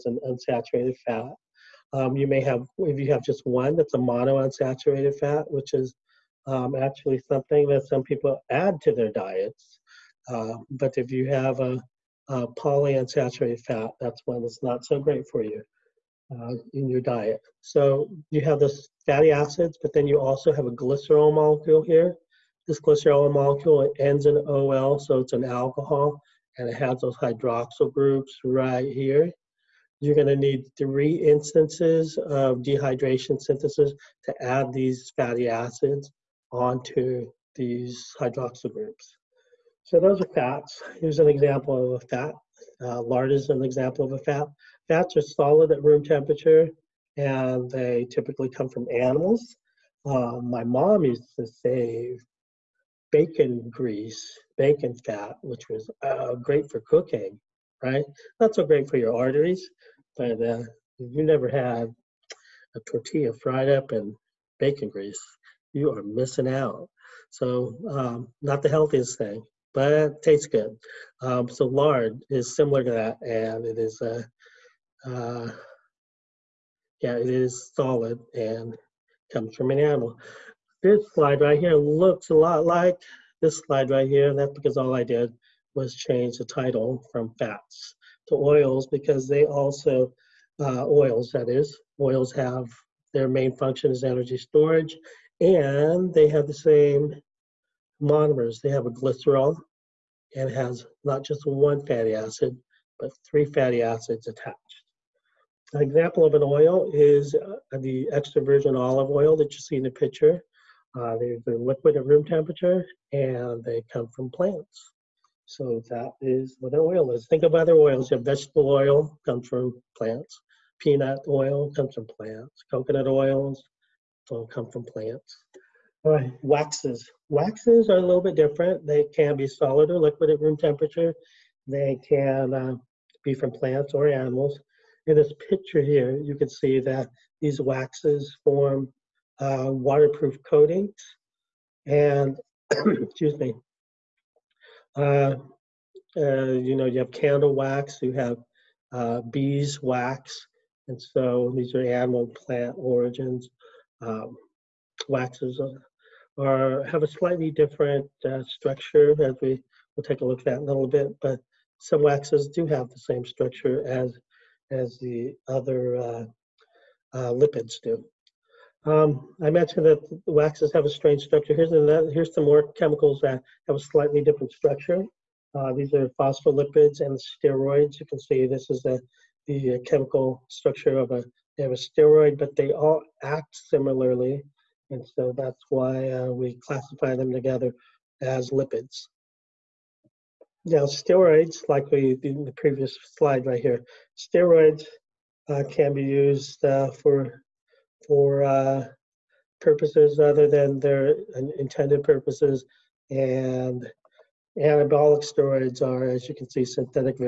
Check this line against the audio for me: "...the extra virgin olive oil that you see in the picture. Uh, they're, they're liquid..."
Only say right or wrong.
right.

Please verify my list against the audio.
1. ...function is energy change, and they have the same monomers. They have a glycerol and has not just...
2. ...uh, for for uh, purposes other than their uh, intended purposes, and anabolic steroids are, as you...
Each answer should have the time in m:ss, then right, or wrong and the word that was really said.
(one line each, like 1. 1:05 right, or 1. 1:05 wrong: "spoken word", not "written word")
1. 1:33 wrong: "storage", not "change"
2. 3:16 right.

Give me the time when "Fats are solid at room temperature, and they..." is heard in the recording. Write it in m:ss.
0:44.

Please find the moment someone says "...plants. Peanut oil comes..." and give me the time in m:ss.
1:59.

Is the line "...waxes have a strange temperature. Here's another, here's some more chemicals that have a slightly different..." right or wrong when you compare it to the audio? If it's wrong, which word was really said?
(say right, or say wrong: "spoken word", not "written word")
wrong: "structure", not "temperature".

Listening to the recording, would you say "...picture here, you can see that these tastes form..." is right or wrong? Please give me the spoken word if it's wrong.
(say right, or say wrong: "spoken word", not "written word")
wrong: "waxes", not "tastes".